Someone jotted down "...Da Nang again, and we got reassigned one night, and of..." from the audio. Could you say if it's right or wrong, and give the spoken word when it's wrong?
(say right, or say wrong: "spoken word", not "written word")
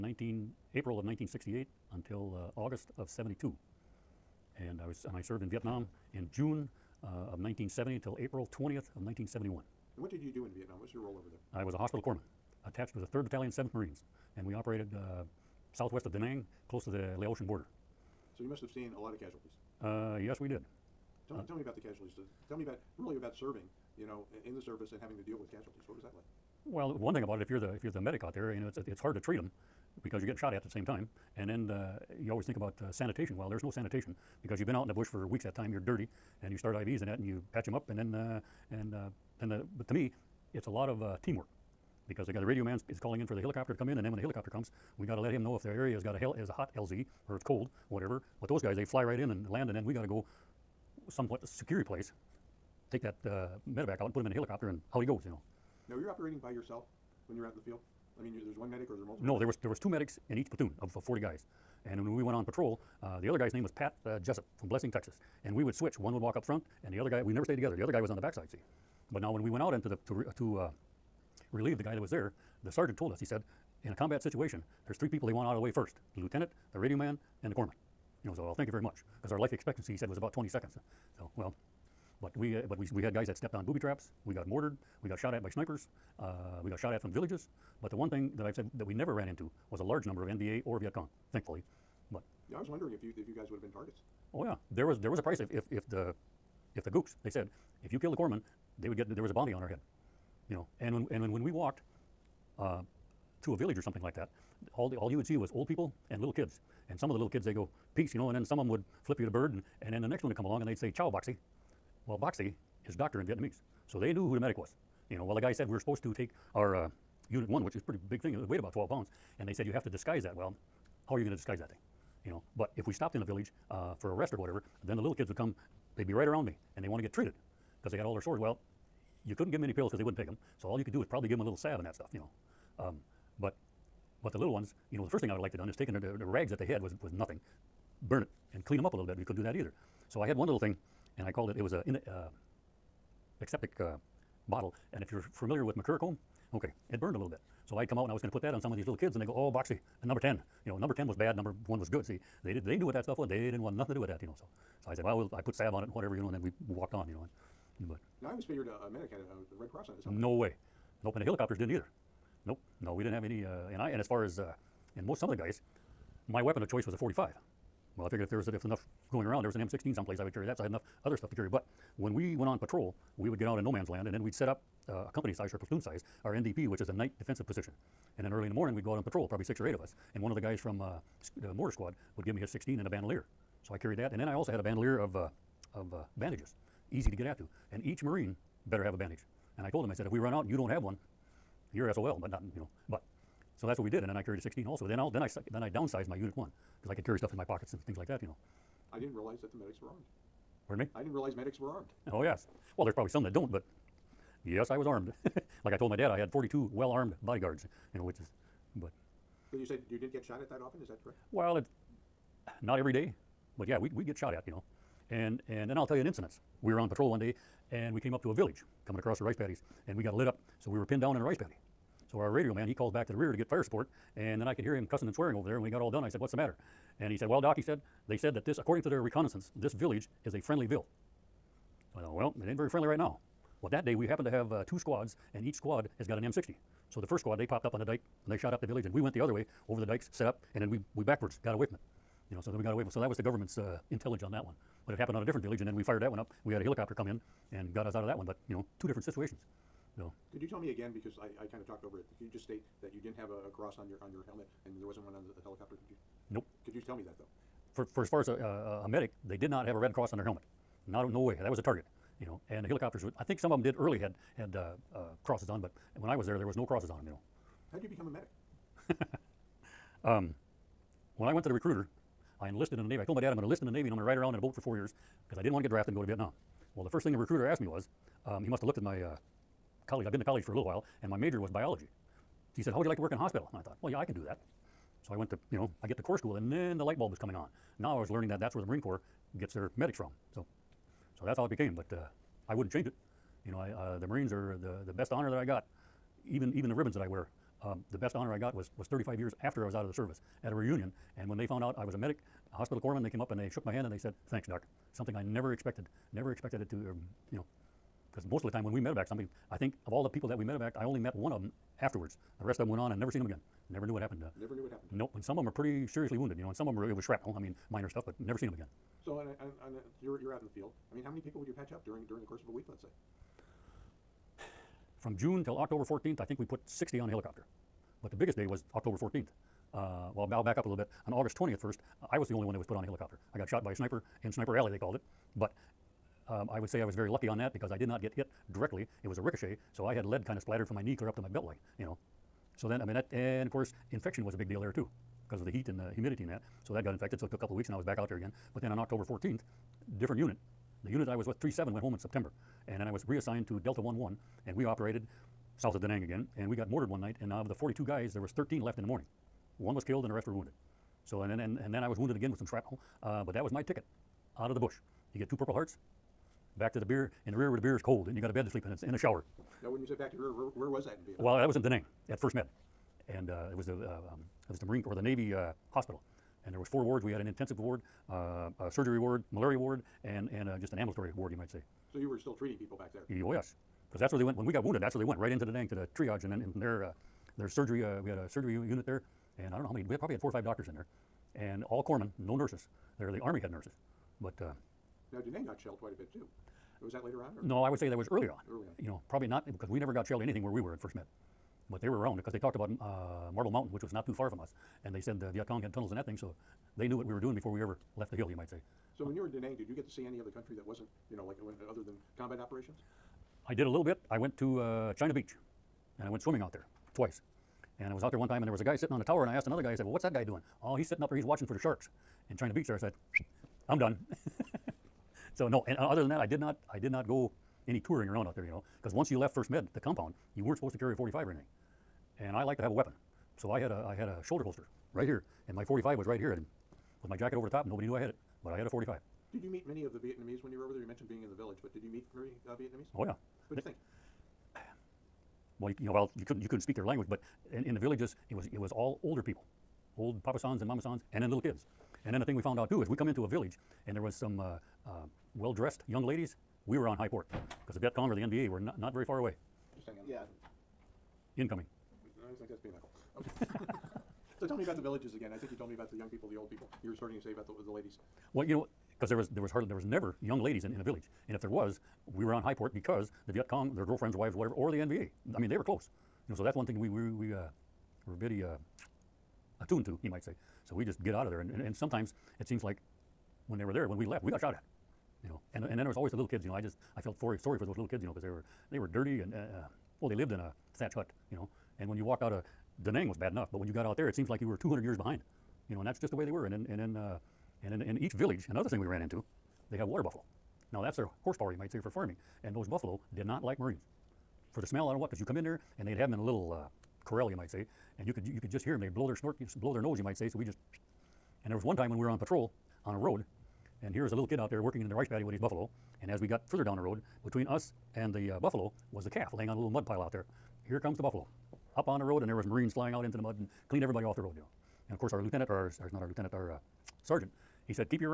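wrong: "mortared", not "reassigned".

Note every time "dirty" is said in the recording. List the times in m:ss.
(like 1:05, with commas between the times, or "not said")
0:35, 8:08.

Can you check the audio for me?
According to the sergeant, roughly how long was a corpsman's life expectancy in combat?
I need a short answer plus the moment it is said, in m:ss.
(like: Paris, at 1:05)
20 seconds, at 1:20.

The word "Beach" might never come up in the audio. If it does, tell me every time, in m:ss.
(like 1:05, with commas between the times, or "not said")
6:55, 7:02.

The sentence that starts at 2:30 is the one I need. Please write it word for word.
You know, number 10 was bad, number one was good.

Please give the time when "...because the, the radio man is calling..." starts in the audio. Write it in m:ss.
0:42.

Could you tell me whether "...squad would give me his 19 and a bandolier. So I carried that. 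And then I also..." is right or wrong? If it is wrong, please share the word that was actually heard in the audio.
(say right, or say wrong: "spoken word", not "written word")
wrong: "16", not "19".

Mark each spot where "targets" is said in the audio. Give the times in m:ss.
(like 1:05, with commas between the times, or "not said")
1:33, 4:21.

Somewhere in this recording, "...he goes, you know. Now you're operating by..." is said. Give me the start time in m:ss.
0:55.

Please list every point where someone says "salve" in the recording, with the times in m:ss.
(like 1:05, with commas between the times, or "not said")
2:11, 2:35.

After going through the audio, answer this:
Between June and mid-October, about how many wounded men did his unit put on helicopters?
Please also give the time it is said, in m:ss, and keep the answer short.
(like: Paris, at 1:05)
60, at 5:26.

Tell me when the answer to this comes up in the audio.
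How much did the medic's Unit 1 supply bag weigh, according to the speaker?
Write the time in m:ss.
1:58.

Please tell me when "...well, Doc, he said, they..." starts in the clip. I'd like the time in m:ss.
3:47.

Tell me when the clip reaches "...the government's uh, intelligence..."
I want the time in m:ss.
4:03.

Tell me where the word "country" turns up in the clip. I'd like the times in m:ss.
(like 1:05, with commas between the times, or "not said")
6:50.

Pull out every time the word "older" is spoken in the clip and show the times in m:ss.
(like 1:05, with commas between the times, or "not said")
7:29.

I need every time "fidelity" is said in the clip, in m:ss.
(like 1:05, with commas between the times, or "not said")
not said.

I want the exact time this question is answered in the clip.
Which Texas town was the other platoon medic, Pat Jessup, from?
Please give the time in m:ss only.
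1:04.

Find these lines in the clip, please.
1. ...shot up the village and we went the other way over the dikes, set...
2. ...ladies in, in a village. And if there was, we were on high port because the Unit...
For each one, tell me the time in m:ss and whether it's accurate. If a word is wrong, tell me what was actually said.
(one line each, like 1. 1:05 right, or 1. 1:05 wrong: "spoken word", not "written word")
1. 3:58 right
2. 7:50 wrong: "Viet", not "Unit".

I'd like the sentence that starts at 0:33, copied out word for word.
Well, there's no sanitation because you've been out in the bush for weeks at a time.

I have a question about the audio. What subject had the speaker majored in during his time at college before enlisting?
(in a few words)
Biology.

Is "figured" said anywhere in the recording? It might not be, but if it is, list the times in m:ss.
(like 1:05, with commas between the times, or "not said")
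2:38, 2:48.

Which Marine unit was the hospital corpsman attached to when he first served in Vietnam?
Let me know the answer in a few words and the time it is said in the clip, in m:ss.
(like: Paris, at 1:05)
3rd Battalion, 7th Marines, at 0:13.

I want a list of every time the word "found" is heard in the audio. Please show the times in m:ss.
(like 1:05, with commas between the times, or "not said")
5:01, 7:32.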